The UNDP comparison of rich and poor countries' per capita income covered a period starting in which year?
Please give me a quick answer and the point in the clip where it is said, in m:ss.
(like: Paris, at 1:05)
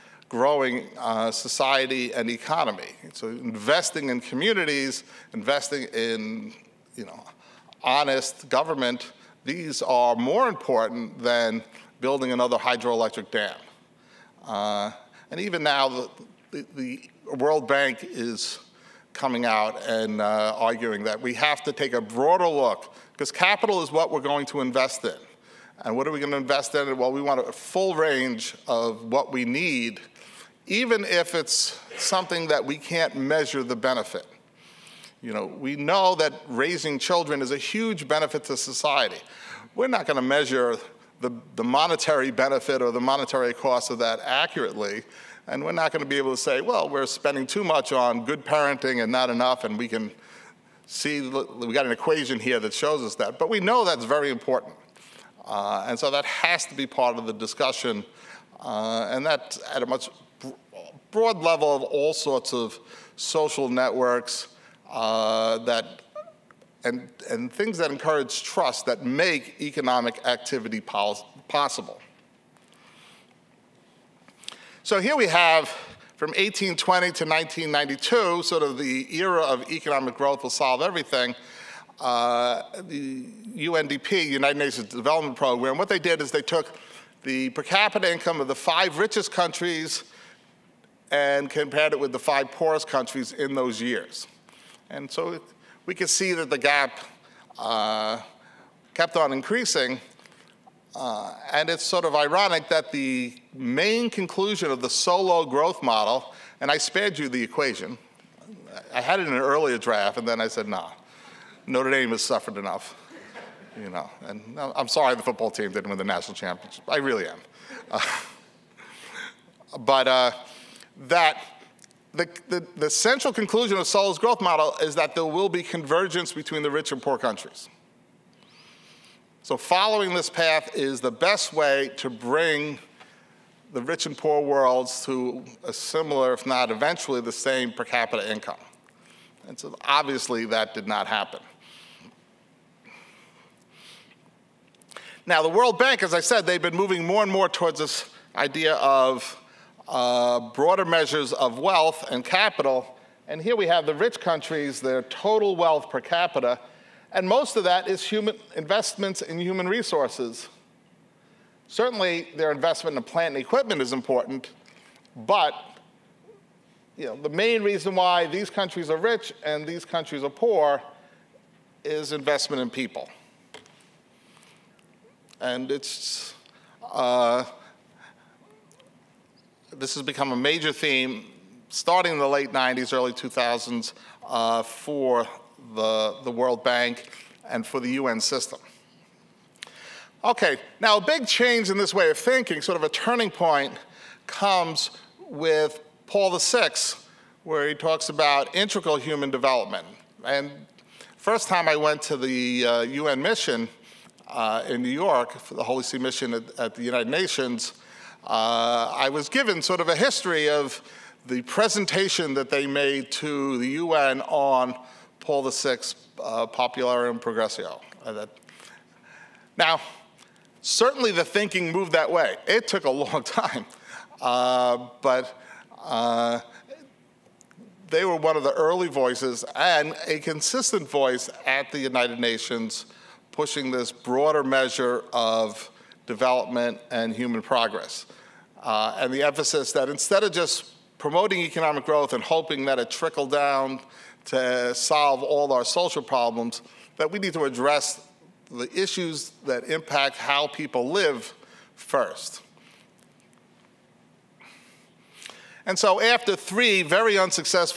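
1820, at 1:16.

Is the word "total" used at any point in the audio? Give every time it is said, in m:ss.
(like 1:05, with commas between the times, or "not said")
2:35.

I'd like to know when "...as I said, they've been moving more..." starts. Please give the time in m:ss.
2:26.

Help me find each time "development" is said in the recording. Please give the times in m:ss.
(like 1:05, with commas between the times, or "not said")
1:24, 3:19, 3:56.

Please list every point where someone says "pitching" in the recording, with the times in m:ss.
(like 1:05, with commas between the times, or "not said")
not said.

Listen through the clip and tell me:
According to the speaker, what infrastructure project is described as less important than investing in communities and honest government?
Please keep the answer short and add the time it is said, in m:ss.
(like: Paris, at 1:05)
hydroelectric dam, at 0:12.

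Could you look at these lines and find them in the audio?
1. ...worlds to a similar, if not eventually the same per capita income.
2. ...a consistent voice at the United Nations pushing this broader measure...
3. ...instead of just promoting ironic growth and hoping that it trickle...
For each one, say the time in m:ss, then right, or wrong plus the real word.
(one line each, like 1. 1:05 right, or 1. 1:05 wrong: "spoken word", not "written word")
1. 2:14 right
2. 3:50 right
3. 3:59 wrong: "economic", not "ironic".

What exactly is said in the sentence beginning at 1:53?
You know, and I'm sorry the football team didn't win the national championship.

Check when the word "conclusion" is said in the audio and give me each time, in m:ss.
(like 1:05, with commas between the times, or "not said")
1:44, 2:03.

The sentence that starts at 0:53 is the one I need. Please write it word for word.
But we know that's very important.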